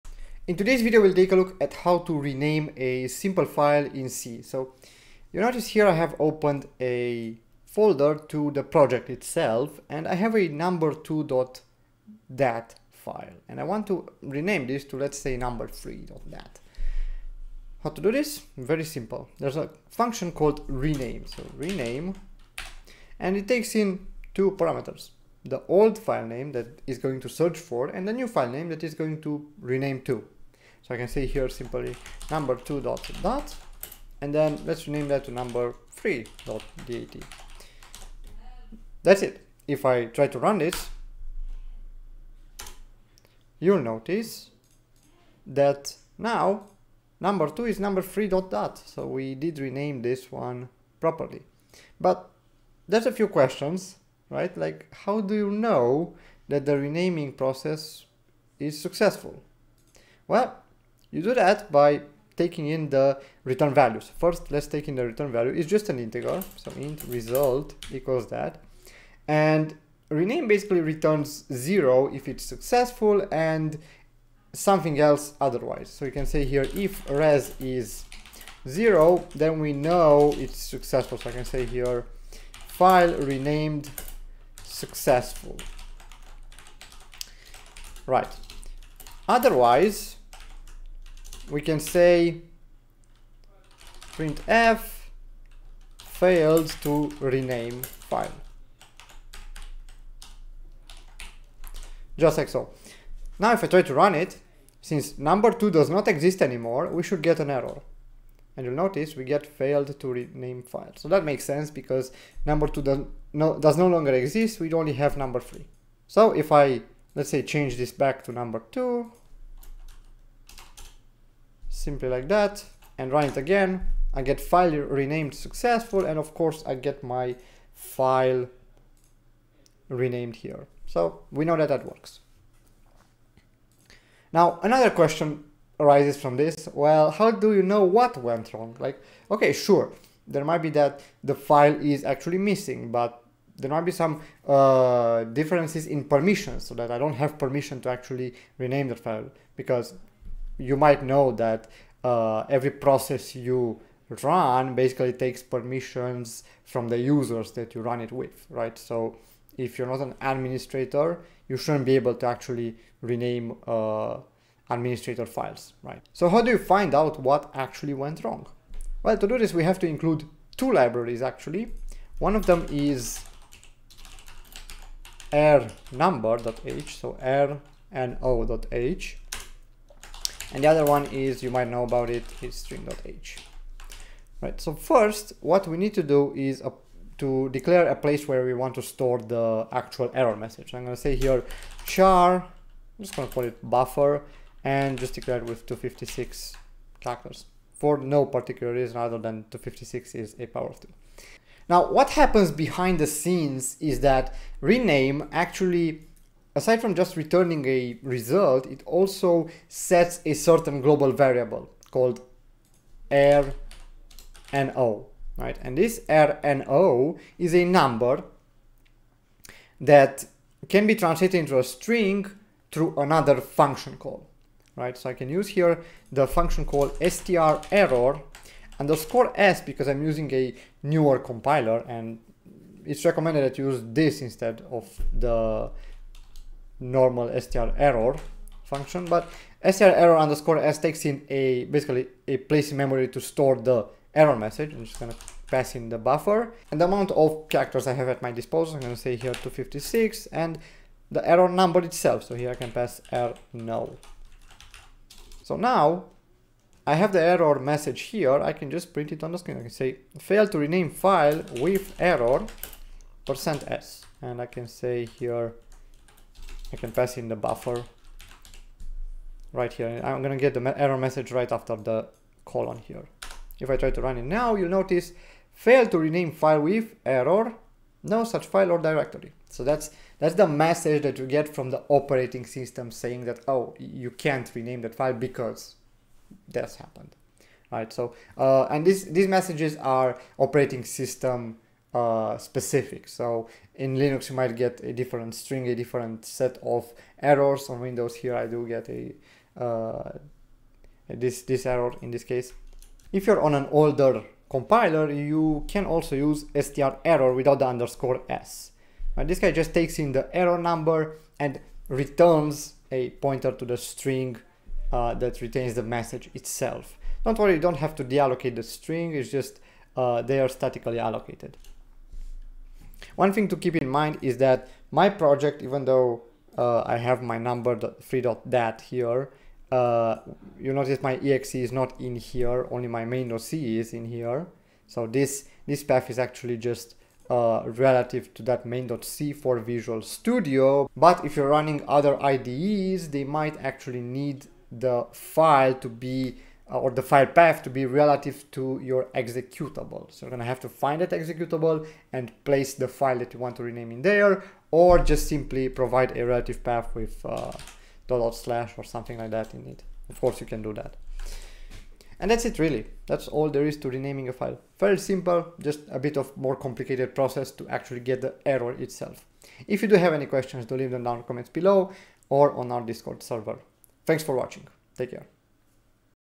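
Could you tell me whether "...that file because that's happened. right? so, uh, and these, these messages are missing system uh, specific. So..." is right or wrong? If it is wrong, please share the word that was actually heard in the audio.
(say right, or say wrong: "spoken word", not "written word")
wrong: "operating", not "missing".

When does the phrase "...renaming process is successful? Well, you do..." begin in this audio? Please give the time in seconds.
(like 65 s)
56 s.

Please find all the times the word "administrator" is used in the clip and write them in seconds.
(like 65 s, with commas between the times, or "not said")
160 s, 164 s.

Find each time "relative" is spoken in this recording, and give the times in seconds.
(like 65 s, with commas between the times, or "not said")
337 s, 347 s, 356 s.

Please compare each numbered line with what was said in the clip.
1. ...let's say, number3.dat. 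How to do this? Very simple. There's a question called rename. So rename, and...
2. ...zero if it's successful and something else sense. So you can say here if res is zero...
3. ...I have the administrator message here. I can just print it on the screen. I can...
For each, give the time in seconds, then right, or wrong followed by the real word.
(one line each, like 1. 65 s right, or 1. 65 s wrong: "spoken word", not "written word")
1. 14 s wrong: "function", not "question"
2. 71 s wrong: "otherwise", not "sense"
3. 256 s wrong: "error", not "administrator".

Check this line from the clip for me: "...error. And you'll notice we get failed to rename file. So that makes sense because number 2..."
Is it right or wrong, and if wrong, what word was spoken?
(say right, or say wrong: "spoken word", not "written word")
right.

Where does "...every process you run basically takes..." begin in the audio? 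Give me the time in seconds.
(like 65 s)
152 s.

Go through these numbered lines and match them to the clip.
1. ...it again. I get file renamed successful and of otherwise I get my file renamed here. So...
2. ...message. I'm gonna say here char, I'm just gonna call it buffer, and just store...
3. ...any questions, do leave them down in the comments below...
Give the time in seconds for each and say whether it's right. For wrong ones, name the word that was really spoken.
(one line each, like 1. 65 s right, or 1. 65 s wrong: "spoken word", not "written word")
1. 123 s wrong: "course", not "otherwise"
2. 190 s wrong: "declare", not "store"
3. 370 s right.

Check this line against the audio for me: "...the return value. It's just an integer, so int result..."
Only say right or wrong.
right.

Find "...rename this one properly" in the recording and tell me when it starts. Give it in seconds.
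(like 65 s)
49 s.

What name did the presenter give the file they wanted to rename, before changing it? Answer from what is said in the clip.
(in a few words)
number2.dat.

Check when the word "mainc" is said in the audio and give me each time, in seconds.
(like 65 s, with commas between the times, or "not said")
333 s, 338 s.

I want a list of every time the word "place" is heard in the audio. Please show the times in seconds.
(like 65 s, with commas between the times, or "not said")
187 s, 242 s, 352 s.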